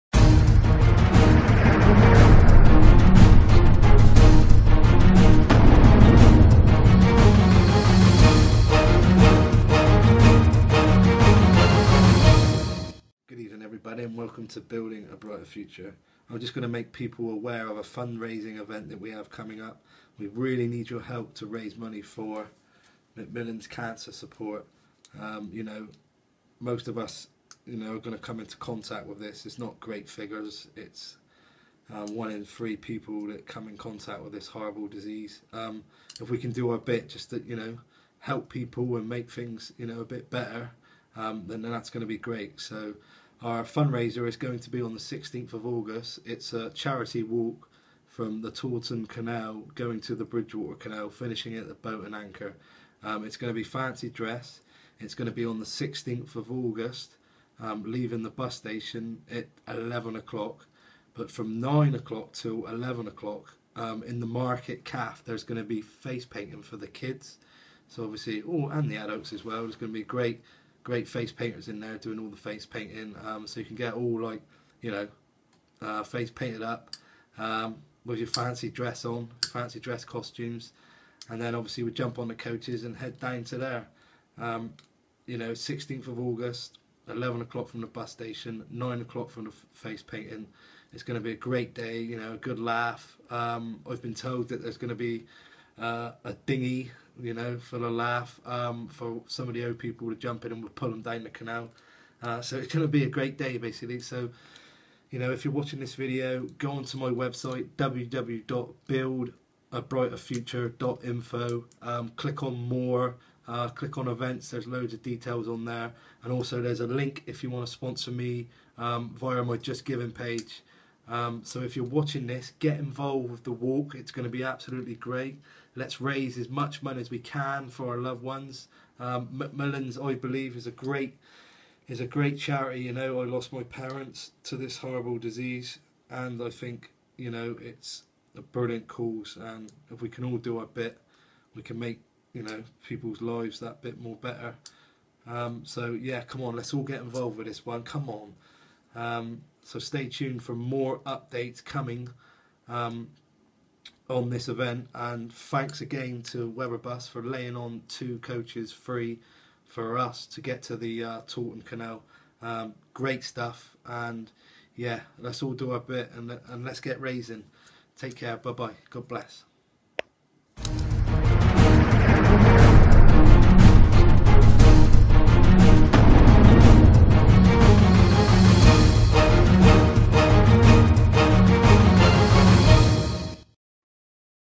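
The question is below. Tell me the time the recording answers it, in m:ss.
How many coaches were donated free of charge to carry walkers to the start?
2:37.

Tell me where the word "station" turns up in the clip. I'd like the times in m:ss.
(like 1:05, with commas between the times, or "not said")
0:58, 1:28.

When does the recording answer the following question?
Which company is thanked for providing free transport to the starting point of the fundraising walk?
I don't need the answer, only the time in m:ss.
2:36.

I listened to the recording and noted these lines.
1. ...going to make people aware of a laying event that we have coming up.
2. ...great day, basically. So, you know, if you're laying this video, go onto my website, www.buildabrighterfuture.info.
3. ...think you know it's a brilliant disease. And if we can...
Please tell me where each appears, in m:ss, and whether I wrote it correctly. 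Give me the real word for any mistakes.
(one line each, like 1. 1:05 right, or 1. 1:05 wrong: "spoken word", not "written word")
1. 0:16 wrong: "fundraising", not "laying"
2. 1:43 wrong: "watching", not "laying"
3. 2:16 wrong: "cause", not "disease".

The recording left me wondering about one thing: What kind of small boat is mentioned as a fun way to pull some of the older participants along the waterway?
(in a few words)
Dinghy.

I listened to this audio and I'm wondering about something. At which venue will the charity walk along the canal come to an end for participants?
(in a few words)
The Boat and Anchor.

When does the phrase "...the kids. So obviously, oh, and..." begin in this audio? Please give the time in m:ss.
1:06.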